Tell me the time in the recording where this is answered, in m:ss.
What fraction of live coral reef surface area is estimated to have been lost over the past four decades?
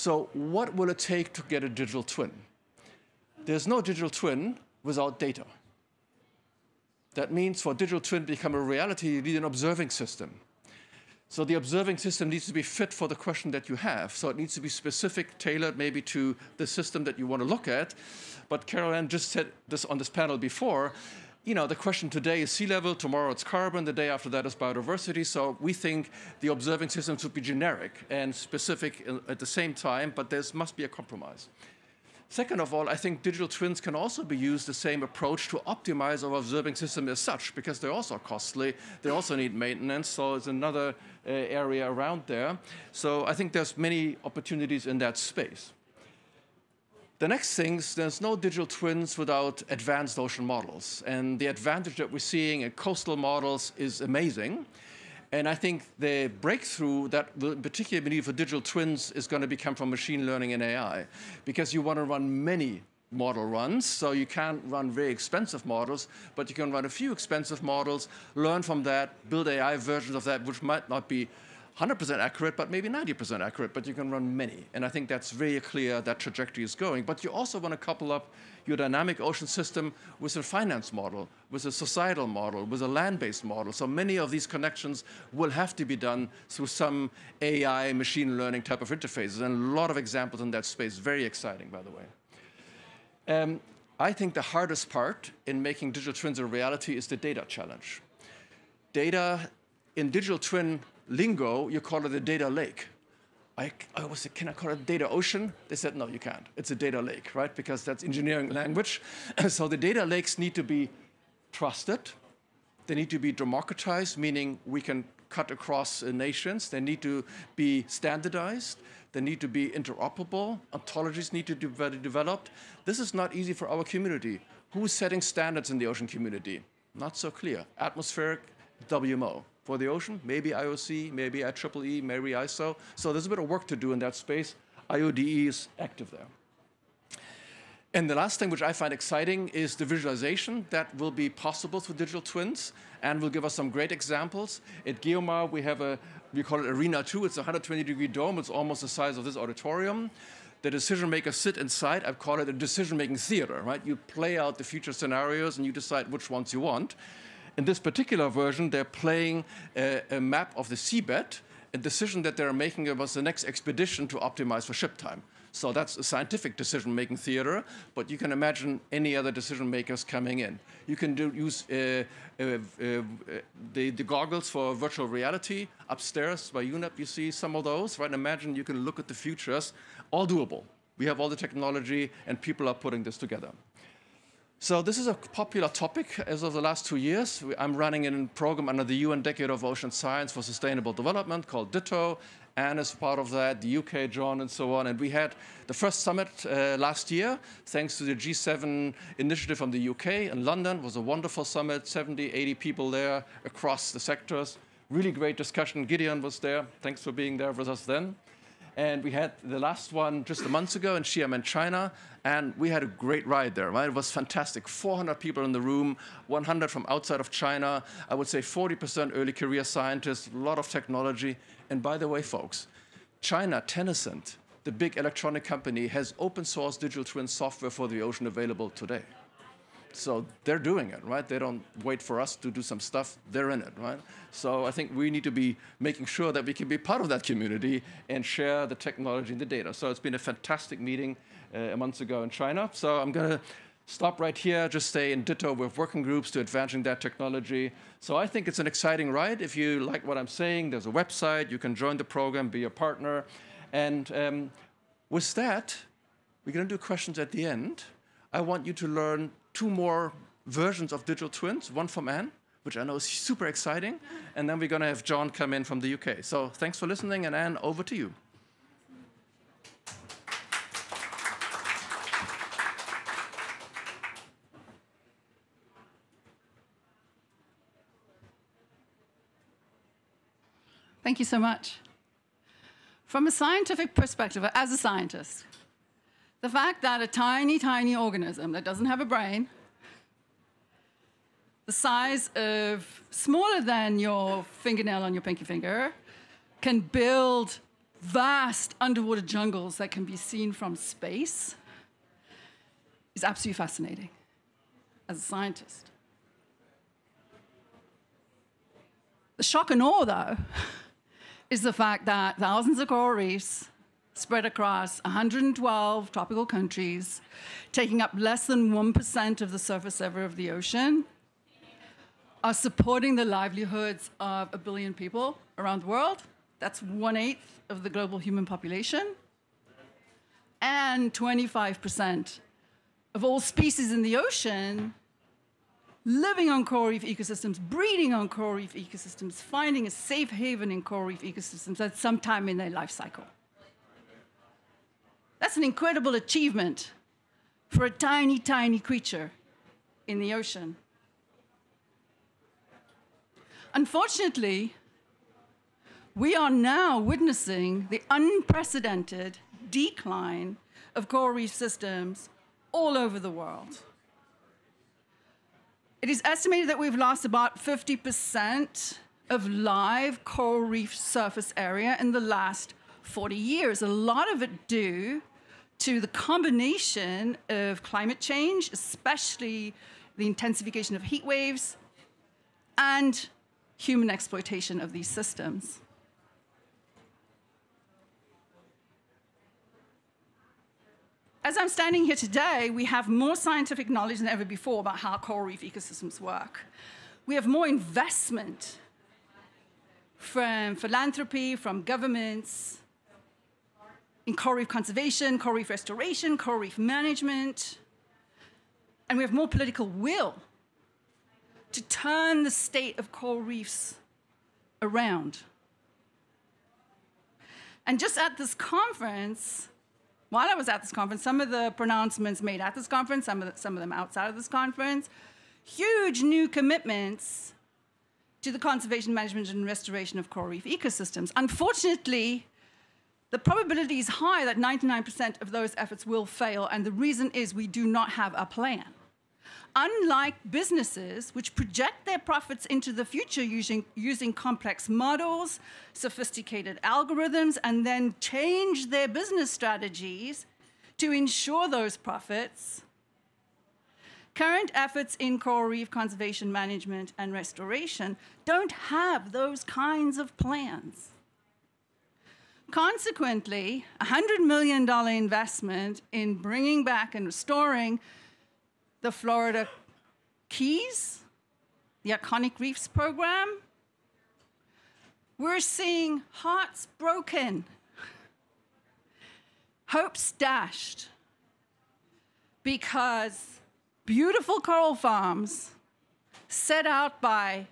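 6:07.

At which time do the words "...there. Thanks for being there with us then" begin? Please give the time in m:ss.
3:26.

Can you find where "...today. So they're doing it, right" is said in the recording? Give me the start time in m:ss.
3:48.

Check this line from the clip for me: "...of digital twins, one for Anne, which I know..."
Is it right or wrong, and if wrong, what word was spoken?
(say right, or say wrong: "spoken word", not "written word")
right.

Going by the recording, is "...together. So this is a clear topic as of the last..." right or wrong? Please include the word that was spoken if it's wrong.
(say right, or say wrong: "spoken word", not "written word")
wrong: "popular", not "clear".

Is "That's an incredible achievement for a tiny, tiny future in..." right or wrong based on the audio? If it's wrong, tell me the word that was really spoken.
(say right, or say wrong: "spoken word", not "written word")
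wrong: "creature", not "future".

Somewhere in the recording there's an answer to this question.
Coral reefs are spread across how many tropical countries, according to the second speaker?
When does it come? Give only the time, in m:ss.
5:15.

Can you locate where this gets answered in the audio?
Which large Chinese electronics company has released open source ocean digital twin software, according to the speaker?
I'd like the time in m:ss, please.
3:43.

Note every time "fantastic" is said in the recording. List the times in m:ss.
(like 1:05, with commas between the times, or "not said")
3:34, 4:00.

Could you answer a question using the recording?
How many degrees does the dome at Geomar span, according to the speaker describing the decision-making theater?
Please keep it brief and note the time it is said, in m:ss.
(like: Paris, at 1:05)
120, at 2:27.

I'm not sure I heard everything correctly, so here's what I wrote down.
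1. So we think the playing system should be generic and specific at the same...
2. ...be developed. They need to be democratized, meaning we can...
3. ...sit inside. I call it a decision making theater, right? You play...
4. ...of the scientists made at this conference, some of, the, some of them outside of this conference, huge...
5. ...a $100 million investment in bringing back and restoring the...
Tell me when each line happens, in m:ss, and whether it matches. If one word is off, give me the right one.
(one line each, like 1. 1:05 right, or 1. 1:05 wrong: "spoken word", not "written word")
1. 0:25 wrong: "observing", not "playing"
2. 1:50 wrong: "trusted", not "developed"
3. 2:31 right
4. 7:01 wrong: "pronouncements", not "scientists"
5. 7:44 right.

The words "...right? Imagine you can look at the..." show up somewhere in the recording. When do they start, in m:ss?
2:57.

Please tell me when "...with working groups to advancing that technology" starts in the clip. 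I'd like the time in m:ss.
4:05.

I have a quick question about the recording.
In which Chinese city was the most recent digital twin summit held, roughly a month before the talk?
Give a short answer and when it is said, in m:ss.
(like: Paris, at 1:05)
Xi'an, at 3:31.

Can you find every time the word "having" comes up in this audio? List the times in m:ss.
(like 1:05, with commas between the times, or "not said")
not said.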